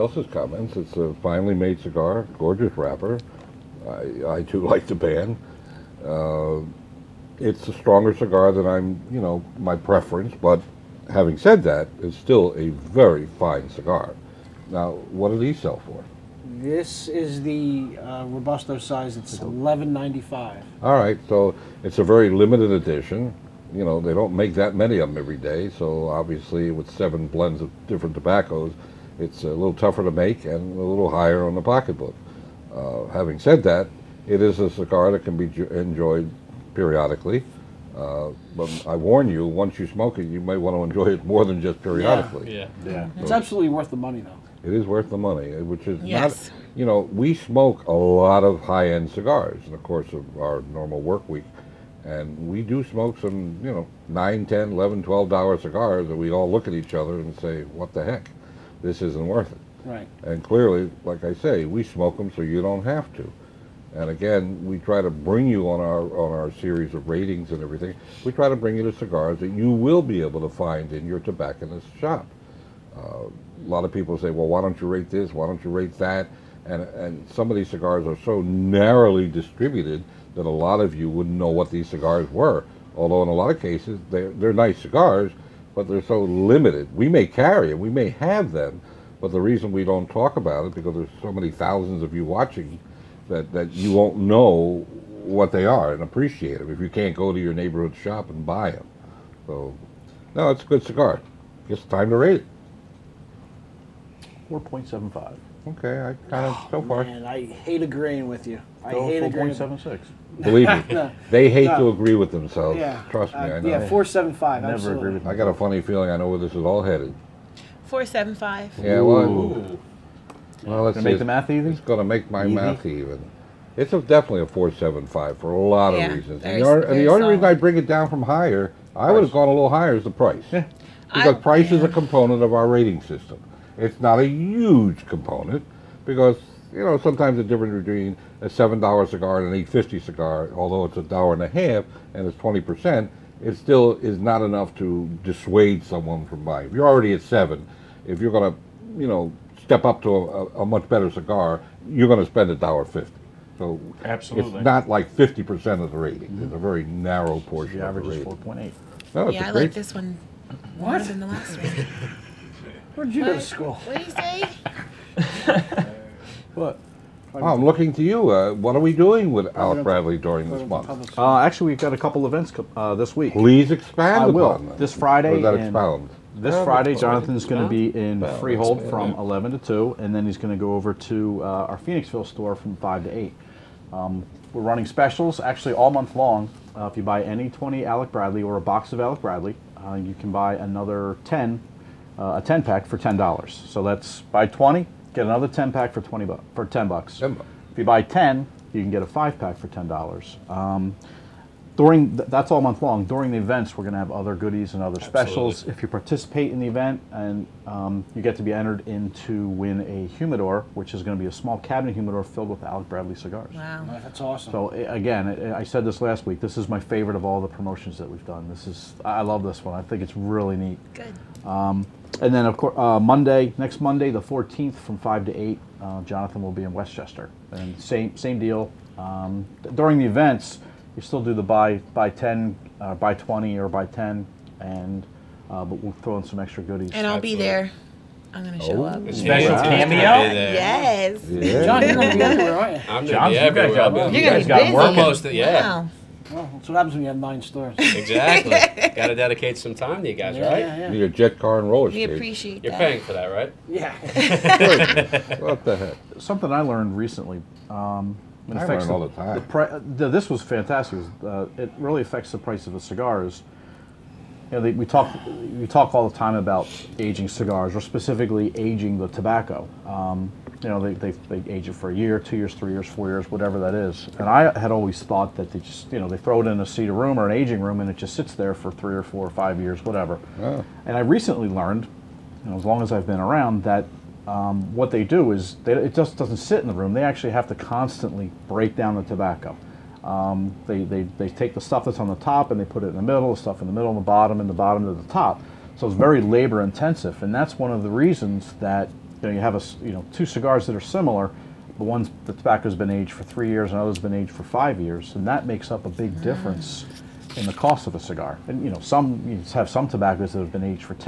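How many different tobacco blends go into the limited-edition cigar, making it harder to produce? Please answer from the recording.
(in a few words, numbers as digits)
7.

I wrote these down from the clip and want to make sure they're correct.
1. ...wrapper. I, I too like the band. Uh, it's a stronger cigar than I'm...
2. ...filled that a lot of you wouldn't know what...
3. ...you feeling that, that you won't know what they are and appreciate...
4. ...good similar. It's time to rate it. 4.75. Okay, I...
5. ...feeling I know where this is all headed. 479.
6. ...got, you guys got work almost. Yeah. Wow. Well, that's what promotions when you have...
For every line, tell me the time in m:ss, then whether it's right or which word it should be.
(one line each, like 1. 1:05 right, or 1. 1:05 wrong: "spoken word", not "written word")
1. 0:02 right
2. 1:19 wrong: "distributed", not "filled"
3. 1:32 wrong: "watching", not "feeling"
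4. 1:40 wrong: "cigar", not "similar"
5. 1:55 wrong: "475", not "479"
6. 4:03 wrong: "happens", not "promotions".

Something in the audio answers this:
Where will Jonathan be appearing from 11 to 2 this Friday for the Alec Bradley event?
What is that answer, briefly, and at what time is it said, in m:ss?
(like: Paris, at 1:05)
Freehold, at 2:58.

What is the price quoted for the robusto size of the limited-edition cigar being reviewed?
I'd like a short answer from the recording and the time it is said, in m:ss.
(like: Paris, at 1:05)
$11.95, at 0:19.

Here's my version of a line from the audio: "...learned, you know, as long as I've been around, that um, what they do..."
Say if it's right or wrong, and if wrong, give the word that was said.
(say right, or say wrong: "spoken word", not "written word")
right.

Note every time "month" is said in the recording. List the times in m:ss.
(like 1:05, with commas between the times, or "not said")
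2:50, 3:05, 3:22.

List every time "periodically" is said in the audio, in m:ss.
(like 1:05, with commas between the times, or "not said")
0:36, 0:41.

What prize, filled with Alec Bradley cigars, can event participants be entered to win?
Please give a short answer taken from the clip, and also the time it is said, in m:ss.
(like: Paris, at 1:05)
a small cabinet humidor, at 3:31.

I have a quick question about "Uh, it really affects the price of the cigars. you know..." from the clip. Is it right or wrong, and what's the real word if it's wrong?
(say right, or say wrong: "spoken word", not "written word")
right.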